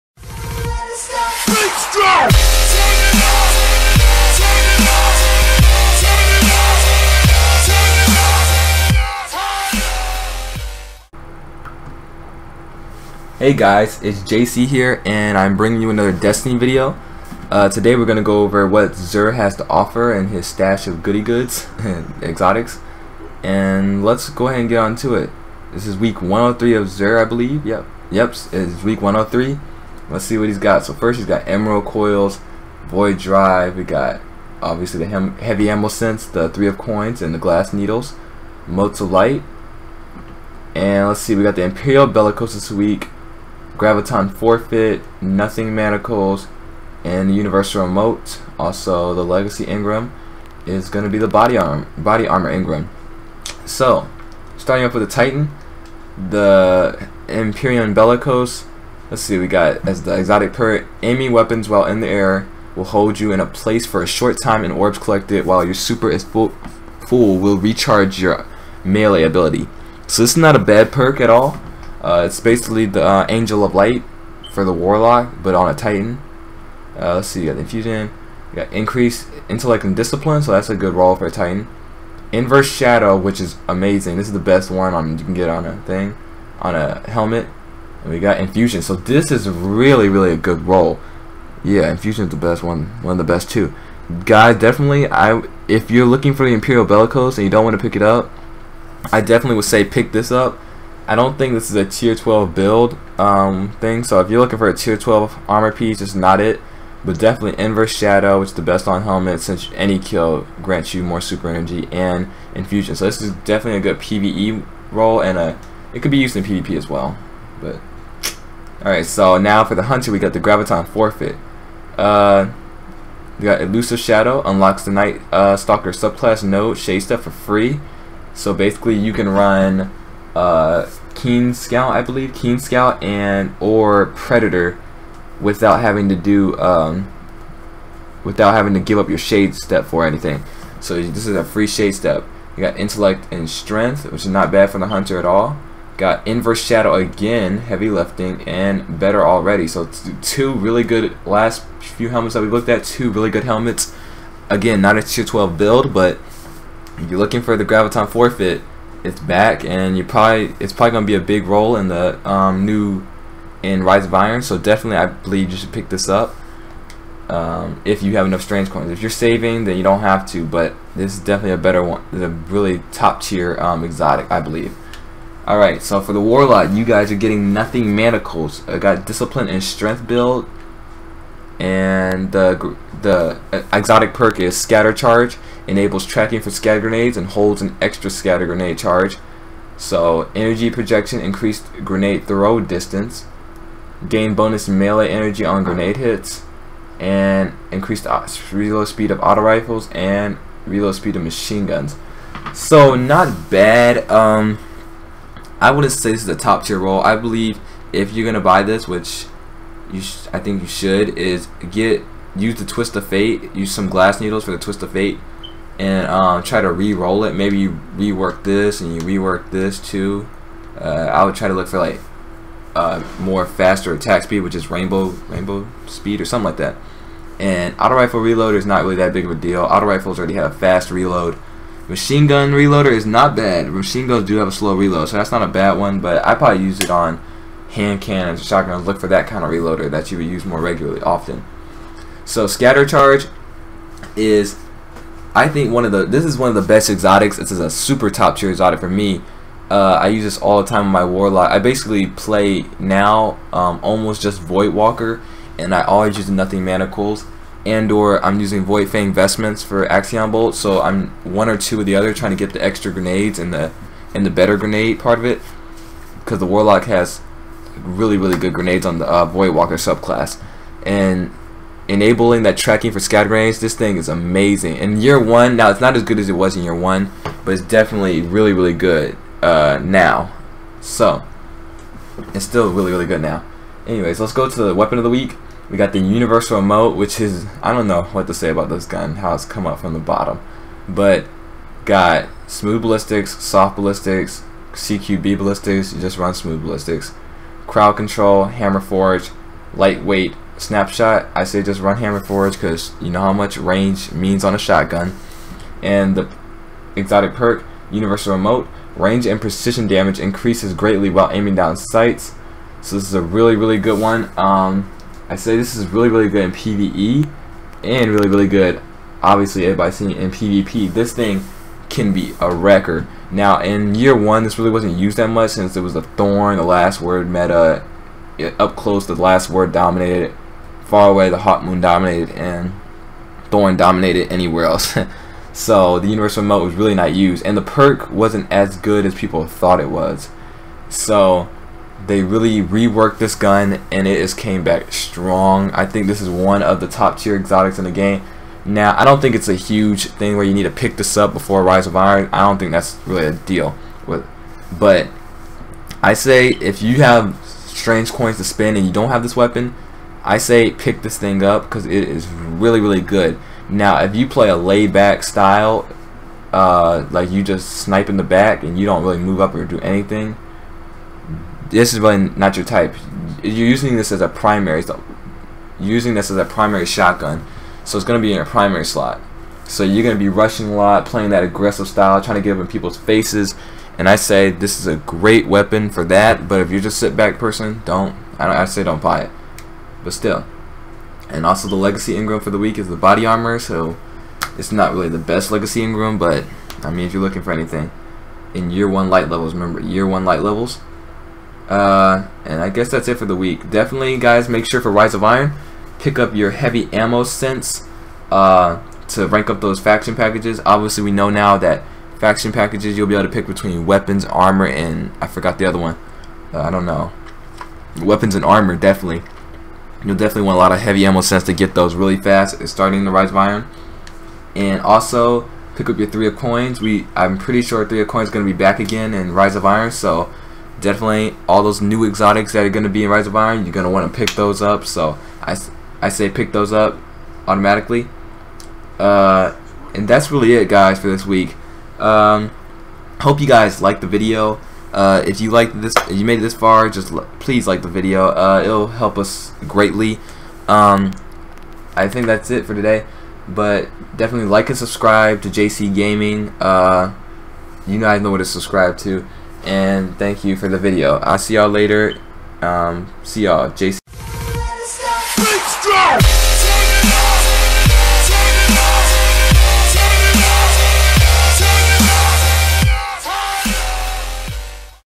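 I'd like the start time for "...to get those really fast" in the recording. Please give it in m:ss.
7:01.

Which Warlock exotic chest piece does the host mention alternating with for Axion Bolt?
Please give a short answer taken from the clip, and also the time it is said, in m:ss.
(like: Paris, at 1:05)
Void Fang Vestments, at 4:18.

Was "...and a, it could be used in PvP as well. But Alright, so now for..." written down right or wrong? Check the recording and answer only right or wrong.
right.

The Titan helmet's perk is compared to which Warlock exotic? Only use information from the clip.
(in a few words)
Angel of Light.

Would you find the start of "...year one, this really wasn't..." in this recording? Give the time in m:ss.
5:23.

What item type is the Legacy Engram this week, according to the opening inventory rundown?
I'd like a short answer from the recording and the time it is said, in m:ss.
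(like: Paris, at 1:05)
Body Armor Engram, at 0:51.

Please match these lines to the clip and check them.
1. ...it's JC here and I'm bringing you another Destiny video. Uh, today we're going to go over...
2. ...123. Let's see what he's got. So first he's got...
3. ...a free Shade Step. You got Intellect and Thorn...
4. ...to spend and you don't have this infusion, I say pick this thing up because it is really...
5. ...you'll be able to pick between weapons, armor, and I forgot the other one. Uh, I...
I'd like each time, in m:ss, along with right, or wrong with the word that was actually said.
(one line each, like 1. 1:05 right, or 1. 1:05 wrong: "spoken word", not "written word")
1. 0:14 right
2. 0:29 wrong: "103", not "123"
3. 2:21 wrong: "Strength", not "Thorn"
4. 5:58 wrong: "weapon", not "infusion"
5. 6:52 right.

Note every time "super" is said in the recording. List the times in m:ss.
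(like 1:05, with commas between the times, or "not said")
1:05, 1:51, 4:07.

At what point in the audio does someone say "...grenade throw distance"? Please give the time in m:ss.
3:11.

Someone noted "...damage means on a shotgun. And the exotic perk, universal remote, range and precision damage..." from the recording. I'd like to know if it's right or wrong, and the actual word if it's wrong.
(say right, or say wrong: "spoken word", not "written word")
wrong: "range", not "damage".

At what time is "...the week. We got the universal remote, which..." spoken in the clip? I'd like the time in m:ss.
4:45.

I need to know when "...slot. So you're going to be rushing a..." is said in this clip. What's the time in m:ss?
6:18.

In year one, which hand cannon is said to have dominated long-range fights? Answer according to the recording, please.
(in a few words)
Hawkmoon.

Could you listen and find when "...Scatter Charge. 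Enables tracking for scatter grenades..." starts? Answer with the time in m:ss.
3:04.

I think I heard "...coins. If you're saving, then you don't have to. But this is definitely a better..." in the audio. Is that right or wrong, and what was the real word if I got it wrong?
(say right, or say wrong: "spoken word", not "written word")
right.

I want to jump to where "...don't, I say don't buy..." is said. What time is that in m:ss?
6:28.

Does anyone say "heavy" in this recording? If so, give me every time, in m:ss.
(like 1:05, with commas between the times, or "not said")
0:35, 2:27, 6:46, 7:00.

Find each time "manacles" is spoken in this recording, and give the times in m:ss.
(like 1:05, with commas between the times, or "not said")
0:45, 2:57, 4:16.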